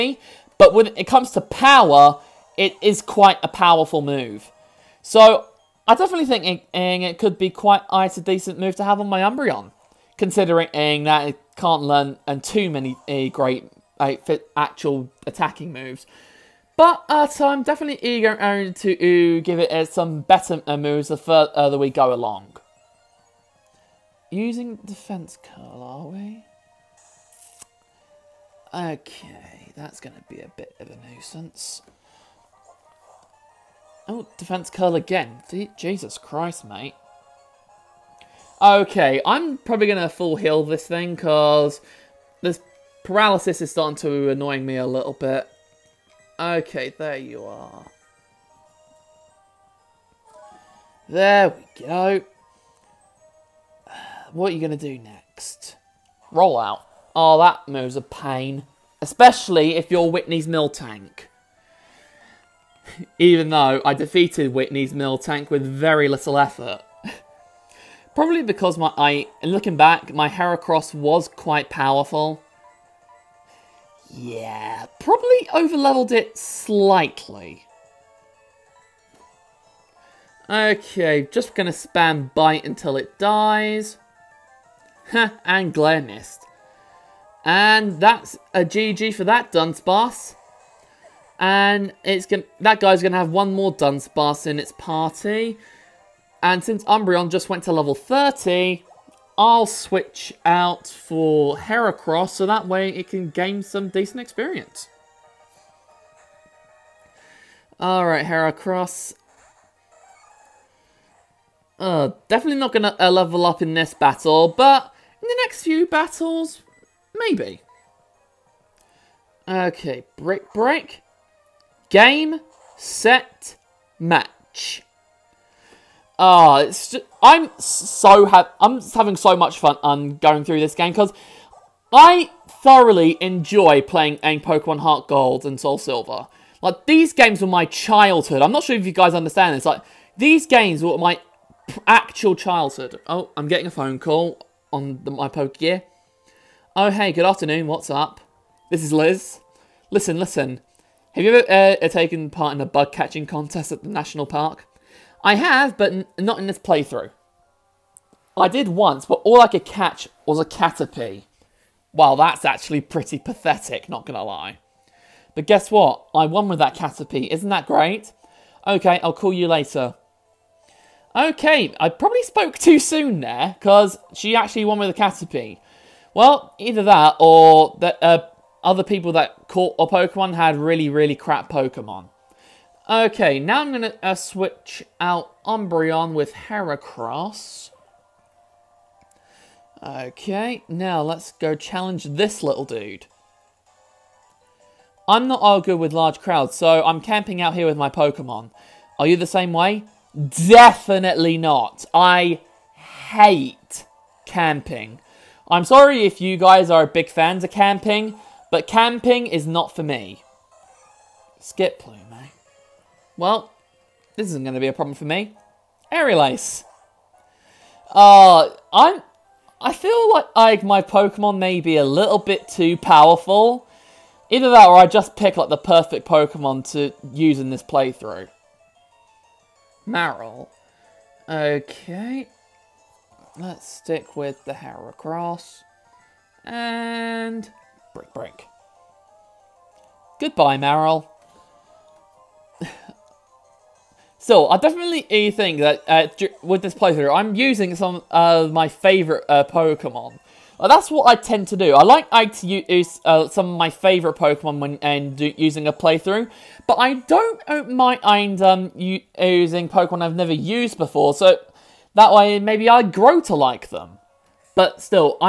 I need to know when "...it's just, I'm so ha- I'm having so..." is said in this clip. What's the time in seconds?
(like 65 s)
126 s.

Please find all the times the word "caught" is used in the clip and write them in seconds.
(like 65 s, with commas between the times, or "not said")
179 s.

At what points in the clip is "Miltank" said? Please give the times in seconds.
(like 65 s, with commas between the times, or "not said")
60 s, 64 s.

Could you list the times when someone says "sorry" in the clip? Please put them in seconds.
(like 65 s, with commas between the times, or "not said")
205 s.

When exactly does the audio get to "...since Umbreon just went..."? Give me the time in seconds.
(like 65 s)
96 s.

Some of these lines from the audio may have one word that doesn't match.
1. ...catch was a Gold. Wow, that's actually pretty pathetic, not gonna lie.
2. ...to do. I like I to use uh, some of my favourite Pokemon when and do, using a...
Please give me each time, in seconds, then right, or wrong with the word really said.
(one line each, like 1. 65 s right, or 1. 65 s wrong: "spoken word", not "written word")
1. 159 s wrong: "Caterpie", not "Gold"
2. 251 s right.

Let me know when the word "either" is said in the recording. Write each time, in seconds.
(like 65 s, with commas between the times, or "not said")
176 s, 224 s.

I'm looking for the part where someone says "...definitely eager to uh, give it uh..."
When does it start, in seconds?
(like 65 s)
17 s.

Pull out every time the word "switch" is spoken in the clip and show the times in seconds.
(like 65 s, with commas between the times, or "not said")
99 s, 184 s.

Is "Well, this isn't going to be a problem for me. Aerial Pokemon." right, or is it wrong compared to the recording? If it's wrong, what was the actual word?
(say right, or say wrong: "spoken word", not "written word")
wrong: "Ace", not "Pokemon".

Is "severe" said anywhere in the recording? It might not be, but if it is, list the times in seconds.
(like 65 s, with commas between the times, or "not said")
not said.